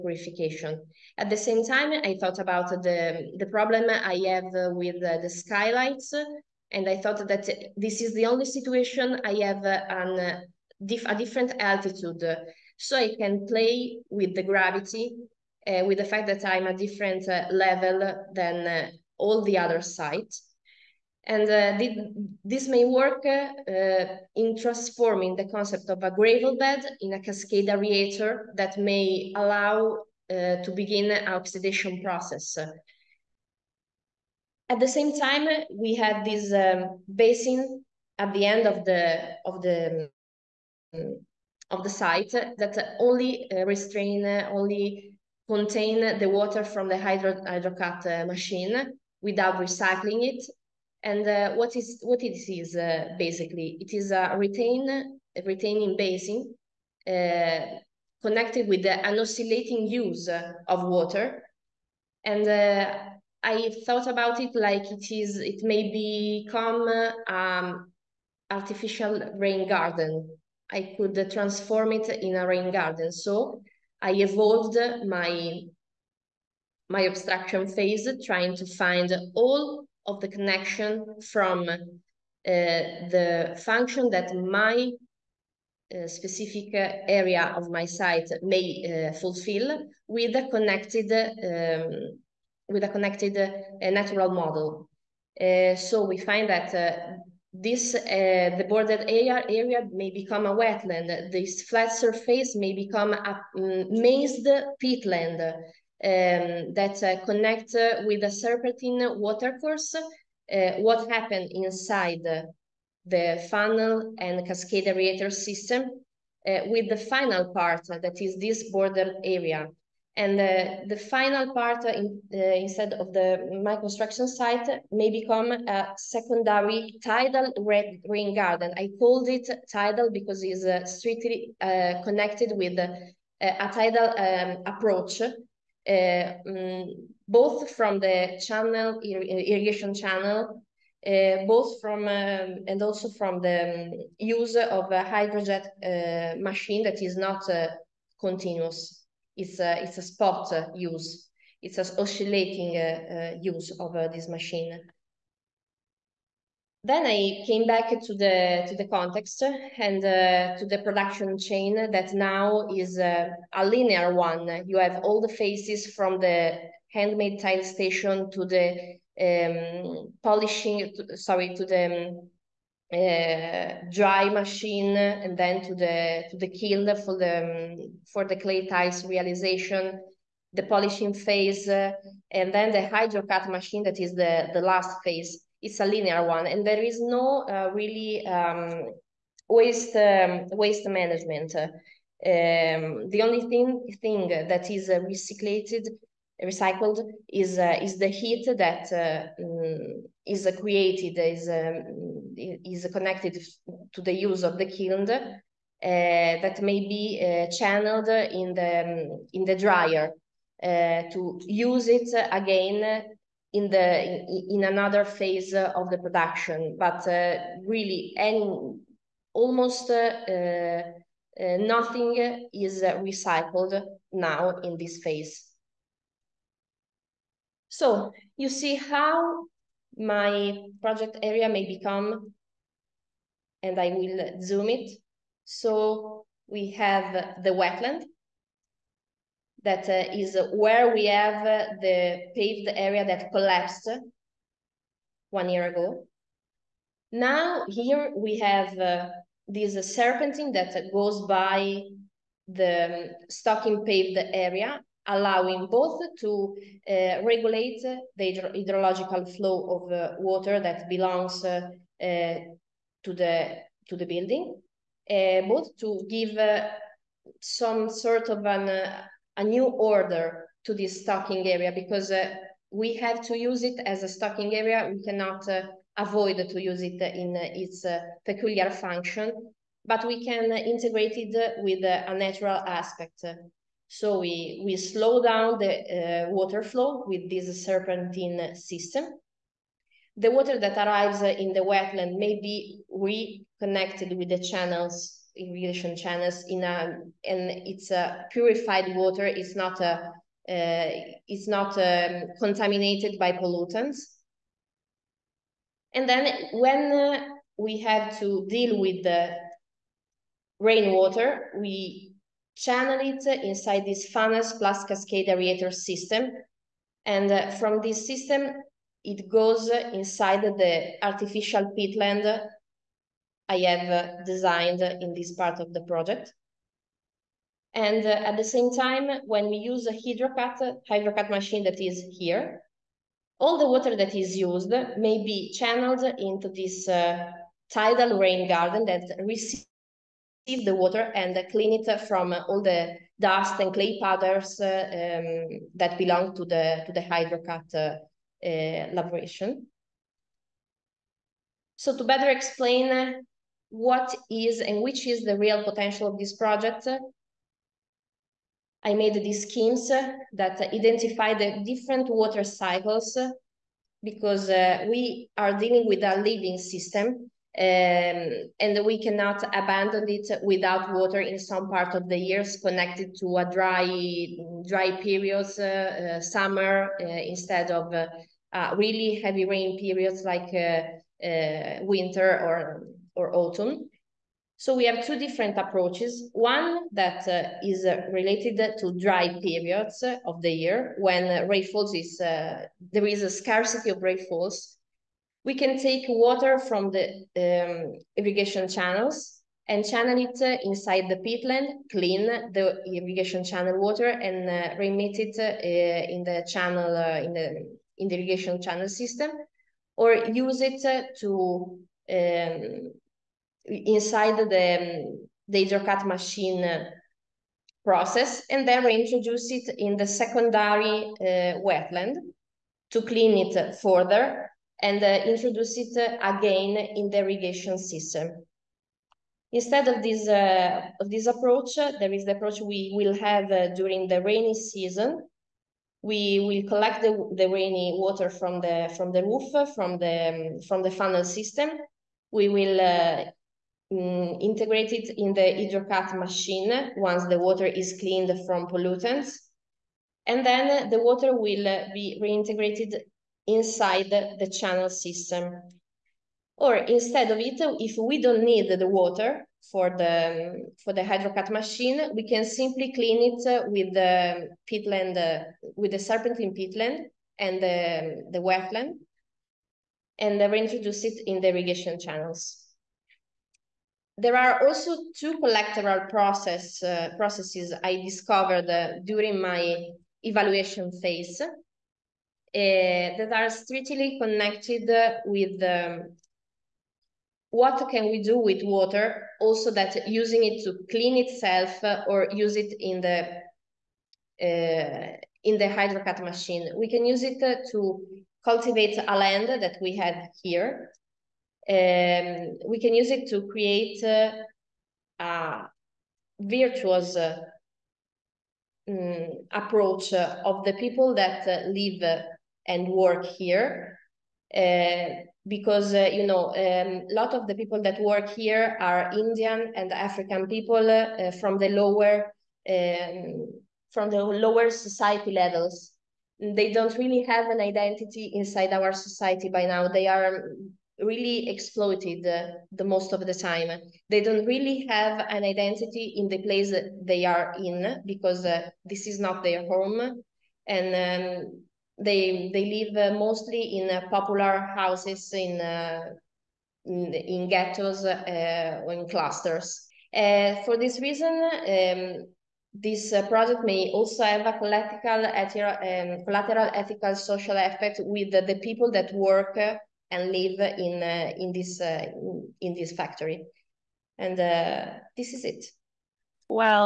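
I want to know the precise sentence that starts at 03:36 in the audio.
But uh, really, any almost uh, nothing is recycled now in this phase.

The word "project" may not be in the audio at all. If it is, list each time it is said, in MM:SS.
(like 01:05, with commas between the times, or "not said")
03:50, 05:25, 05:56, 09:13.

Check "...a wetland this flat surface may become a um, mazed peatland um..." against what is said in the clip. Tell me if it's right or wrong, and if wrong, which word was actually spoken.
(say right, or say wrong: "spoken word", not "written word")
right.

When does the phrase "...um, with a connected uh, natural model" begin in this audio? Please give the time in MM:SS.
01:31.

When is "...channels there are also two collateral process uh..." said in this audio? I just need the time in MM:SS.
07:51.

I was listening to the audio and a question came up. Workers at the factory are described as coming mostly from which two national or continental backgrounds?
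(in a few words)
Indian and African.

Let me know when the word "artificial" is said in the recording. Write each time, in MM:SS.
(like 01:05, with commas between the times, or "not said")
01:08, 05:21.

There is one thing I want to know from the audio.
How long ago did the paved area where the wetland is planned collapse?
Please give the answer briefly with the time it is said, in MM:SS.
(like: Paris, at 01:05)
one year ago, at 04:05.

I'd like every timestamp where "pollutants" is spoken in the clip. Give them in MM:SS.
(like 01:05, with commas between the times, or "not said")
05:03, 07:28.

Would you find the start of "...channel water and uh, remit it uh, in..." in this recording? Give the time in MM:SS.
06:43.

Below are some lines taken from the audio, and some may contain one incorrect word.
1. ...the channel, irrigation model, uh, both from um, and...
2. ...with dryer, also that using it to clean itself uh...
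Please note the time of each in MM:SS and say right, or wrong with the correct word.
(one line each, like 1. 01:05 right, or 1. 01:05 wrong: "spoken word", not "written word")
1. 02:17 wrong: "channel", not "model"
2. 08:08 wrong: "water", not "dryer".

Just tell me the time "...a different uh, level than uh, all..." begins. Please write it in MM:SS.
00:16.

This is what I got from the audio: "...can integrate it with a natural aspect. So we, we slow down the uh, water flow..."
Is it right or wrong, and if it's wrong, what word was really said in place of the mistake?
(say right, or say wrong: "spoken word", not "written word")
right.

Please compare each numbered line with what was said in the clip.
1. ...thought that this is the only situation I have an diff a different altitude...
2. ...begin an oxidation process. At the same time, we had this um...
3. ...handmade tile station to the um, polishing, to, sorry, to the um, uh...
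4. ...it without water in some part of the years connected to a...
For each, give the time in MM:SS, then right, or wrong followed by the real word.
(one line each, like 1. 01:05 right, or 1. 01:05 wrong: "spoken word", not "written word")
1. 00:07 right
2. 00:30 right
3. 02:46 right
4. 06:10 right.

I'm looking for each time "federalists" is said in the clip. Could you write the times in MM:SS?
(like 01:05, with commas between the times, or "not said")
not said.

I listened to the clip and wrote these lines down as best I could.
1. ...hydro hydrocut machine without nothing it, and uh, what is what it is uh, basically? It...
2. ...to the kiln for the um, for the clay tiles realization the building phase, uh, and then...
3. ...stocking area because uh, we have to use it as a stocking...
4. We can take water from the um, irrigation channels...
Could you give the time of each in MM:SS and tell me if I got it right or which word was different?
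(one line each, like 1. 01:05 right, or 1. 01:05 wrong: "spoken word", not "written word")
1. 00:46 wrong: "recycling", not "nothing"
2. 02:56 wrong: "polishing", not "building"
3. 04:31 right
4. 06:35 right.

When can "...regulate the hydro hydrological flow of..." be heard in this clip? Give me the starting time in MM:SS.
04:17.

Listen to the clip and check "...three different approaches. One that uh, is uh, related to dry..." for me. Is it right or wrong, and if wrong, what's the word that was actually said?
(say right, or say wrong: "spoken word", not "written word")
wrong: "two", not "three".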